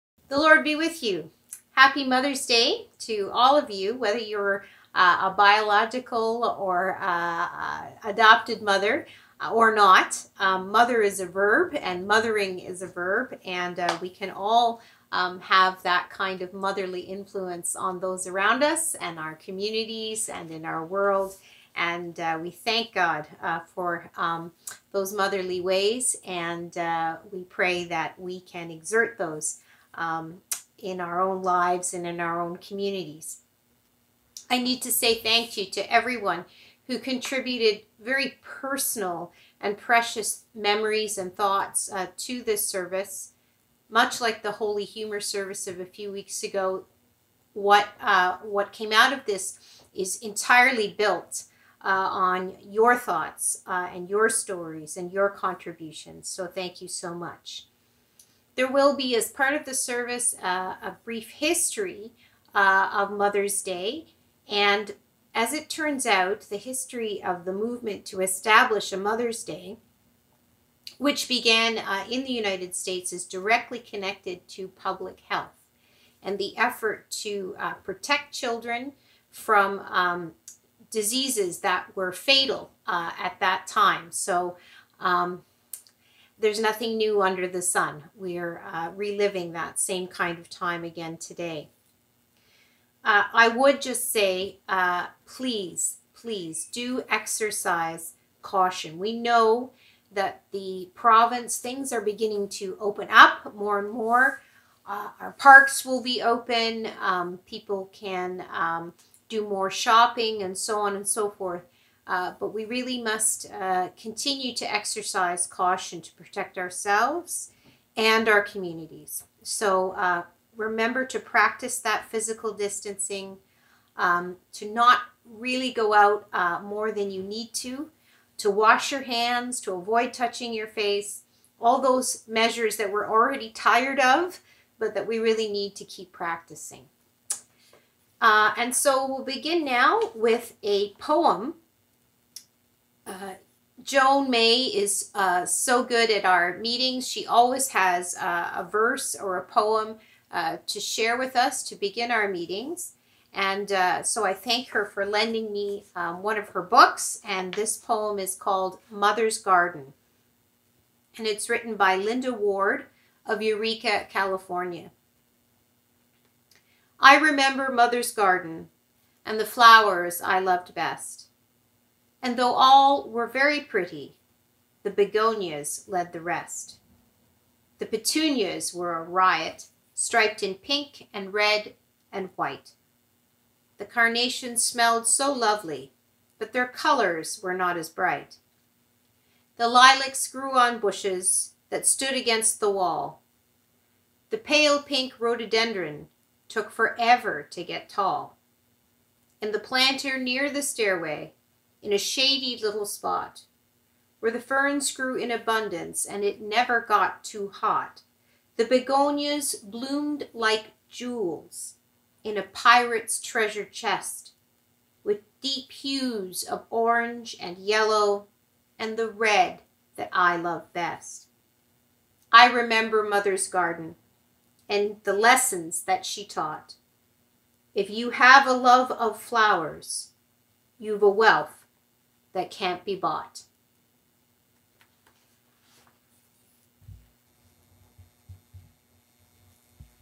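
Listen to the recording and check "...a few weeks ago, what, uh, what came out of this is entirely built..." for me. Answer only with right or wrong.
right.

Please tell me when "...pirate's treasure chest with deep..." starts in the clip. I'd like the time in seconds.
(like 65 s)
212 s.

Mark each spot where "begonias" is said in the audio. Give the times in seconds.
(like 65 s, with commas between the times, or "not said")
174 s, 208 s.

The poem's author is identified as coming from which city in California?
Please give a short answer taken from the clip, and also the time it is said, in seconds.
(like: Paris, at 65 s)
Eureka, at 163 s.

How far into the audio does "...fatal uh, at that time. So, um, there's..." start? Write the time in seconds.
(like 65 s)
82 s.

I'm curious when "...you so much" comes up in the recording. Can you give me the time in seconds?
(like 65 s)
56 s.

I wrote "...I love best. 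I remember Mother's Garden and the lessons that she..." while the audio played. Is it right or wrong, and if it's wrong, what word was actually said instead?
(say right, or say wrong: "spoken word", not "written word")
right.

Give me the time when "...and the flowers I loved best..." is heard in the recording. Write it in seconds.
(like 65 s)
169 s.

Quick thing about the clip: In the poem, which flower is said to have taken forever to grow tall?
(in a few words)
rhododendron.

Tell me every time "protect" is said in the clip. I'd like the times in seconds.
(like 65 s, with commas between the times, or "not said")
77 s, 116 s.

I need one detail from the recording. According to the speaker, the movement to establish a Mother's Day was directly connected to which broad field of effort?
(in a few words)
public health.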